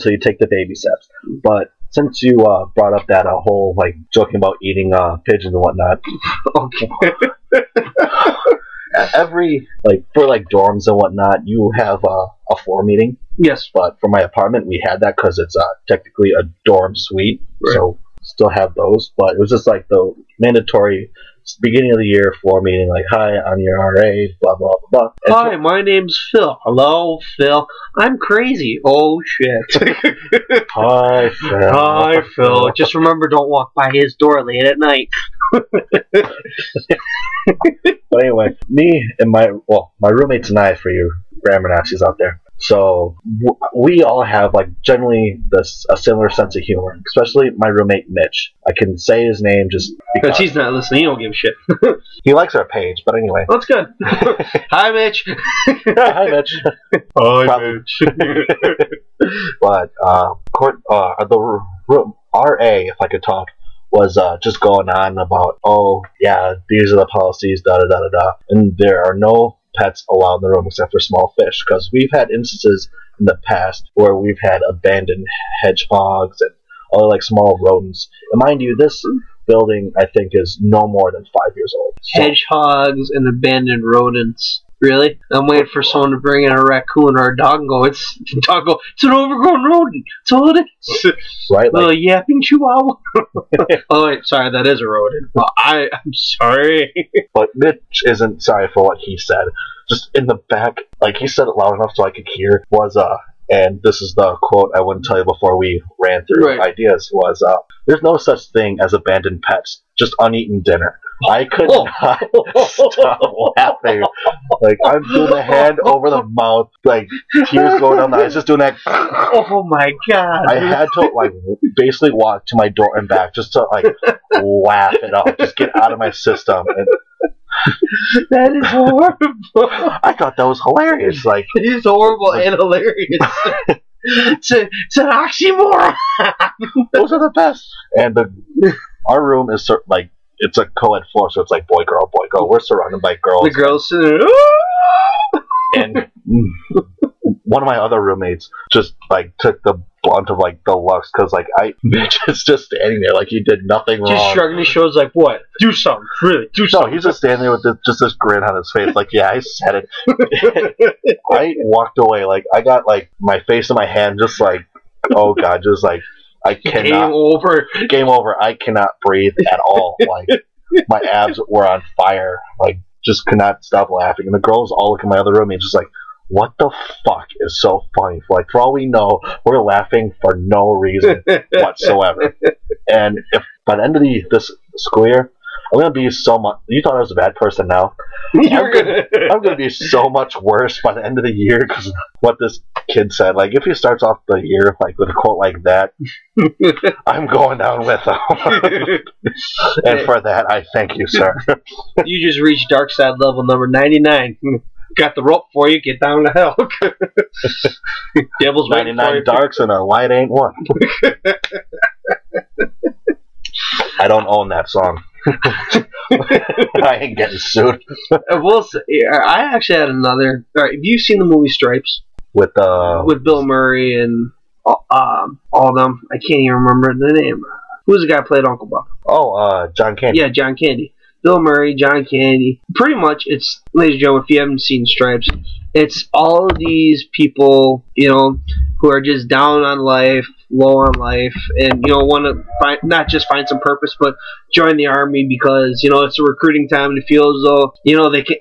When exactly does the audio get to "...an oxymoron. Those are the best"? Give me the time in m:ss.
2:14.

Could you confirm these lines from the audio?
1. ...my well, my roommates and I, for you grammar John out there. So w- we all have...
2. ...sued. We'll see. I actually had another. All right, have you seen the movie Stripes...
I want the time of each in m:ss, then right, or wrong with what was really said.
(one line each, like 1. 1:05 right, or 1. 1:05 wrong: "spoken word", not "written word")
1. 0:39 wrong: "Nazis", not "John"
2. 3:37 right.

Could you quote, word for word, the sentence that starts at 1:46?
ideas was uh, there's no such thing as abandoned pets, just uneaten dinner.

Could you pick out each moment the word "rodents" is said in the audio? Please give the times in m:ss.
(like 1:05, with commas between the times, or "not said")
1:17, 1:23, 1:29, 1:34.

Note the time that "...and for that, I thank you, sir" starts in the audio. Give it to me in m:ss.
3:19.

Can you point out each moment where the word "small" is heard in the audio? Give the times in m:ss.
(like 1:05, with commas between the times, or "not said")
1:10, 1:17.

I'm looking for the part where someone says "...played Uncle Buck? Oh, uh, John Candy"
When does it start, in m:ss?
3:48.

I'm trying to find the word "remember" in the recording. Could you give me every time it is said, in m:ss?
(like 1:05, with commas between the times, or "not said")
0:32, 3:46.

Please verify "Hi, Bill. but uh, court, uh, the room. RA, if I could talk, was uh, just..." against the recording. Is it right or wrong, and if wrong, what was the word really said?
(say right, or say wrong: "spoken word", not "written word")
wrong: "Mitch", not "Bill".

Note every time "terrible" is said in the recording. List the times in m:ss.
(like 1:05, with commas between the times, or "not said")
not said.